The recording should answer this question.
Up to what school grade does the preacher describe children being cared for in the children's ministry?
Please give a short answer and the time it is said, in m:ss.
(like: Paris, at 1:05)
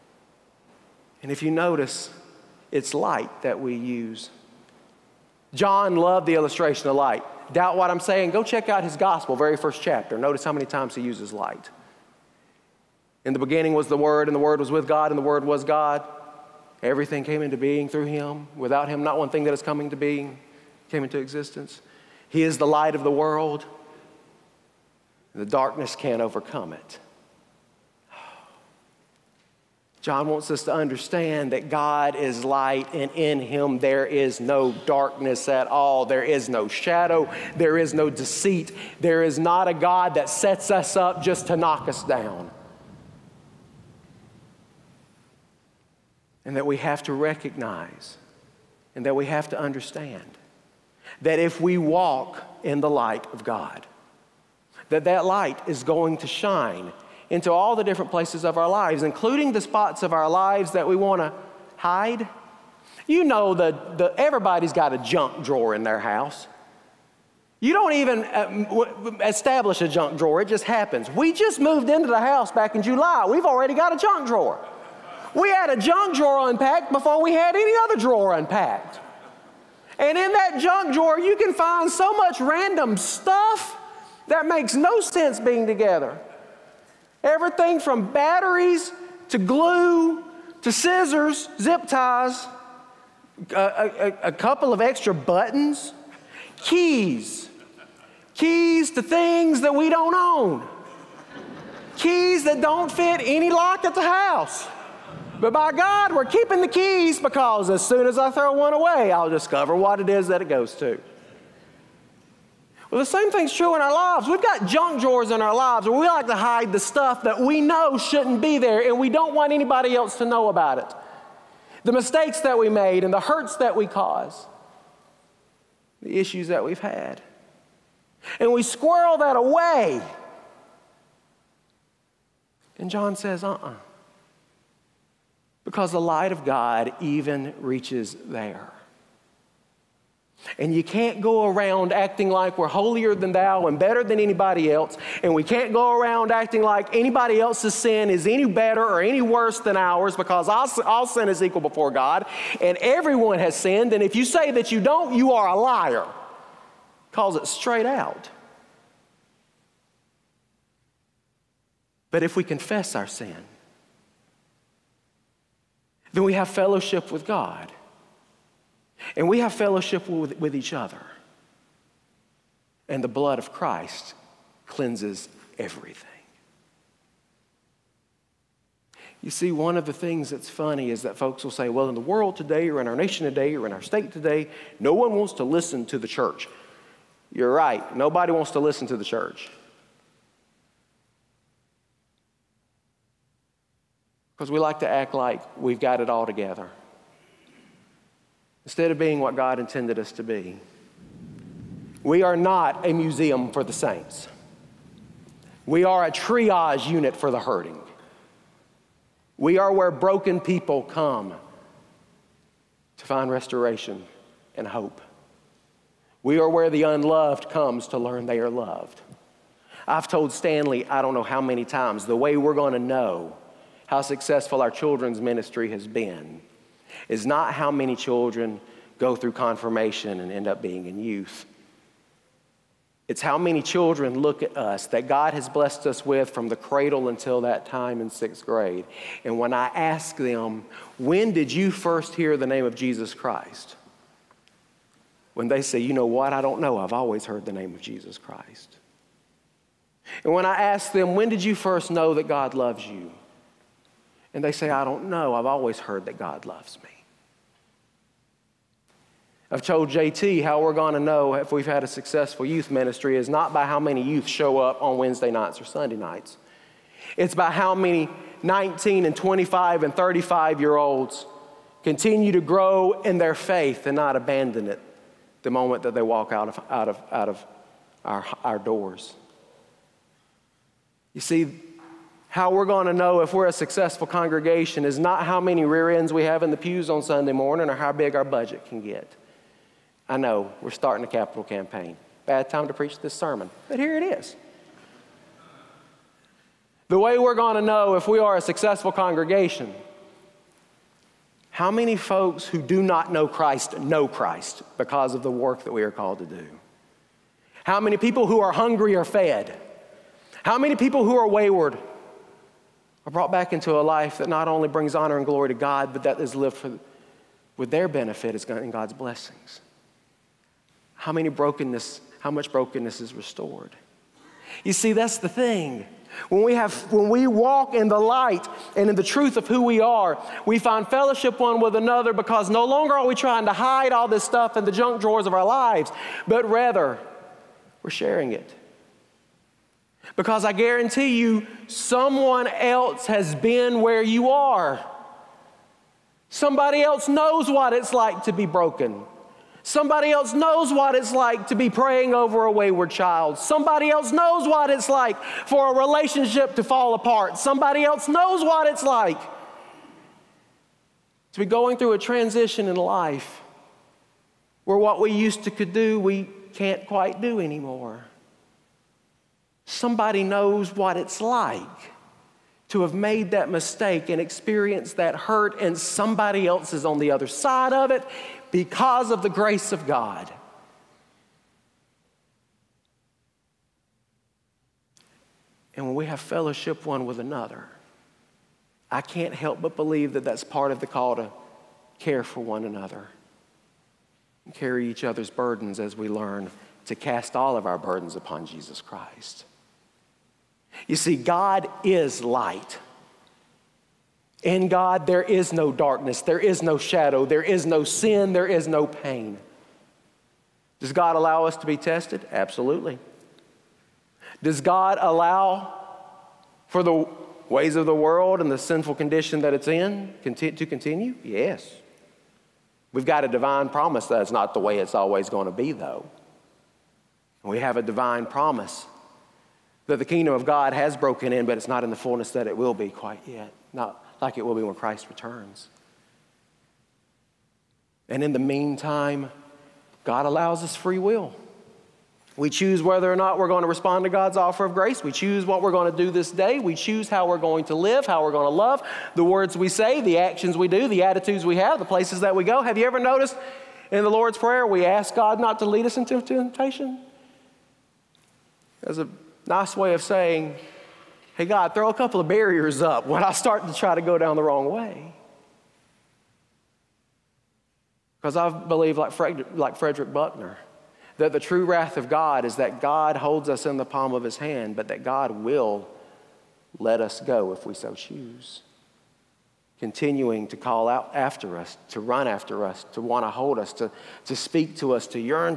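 Sixth grade, at 3:58.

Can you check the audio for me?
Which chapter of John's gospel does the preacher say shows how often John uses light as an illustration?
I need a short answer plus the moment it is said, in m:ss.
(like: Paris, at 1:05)
First chapter, at 0:09.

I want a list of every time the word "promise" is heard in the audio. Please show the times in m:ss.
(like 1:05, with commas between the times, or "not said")
7:03, 7:08.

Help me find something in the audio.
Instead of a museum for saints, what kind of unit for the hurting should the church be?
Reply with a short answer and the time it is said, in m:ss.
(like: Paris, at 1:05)
Triage unit, at 3:26.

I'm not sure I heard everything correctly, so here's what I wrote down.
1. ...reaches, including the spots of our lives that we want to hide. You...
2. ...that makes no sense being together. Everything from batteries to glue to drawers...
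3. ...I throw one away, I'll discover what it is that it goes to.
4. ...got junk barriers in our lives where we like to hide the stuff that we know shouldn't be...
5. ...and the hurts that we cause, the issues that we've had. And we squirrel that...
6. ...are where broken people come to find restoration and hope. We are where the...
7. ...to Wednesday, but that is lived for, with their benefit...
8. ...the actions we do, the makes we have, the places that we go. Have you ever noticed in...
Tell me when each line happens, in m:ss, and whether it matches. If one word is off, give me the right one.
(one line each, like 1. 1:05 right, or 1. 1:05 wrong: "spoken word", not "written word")
1. 0:58 wrong: "lives", not "reaches"
2. 1:24 wrong: "scissors", not "drawers"
3. 1:48 right
4. 1:54 wrong: "drawers", not "barriers"
5. 2:03 right
6. 3:29 right
7. 5:15 wrong: "God", not "Wednesday"
8. 7:30 wrong: "attitudes", not "makes".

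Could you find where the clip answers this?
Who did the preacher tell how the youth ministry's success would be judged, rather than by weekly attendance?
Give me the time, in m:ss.
4:19.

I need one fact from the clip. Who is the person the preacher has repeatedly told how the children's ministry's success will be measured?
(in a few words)
Stanley.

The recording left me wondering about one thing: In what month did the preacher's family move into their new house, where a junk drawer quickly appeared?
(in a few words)
July.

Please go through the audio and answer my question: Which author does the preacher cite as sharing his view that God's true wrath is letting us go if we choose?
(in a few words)
Frederick Buechner.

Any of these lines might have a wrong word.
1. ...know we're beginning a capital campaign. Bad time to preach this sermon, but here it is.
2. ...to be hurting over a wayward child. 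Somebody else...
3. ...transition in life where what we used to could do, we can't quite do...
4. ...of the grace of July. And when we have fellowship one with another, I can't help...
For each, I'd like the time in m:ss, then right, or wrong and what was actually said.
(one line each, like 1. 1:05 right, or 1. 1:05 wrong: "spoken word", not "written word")
1. 4:50 wrong: "starting", not "beginning"
2. 5:51 wrong: "praying", not "hurting"
3. 6:01 right
4. 6:19 wrong: "God", not "July".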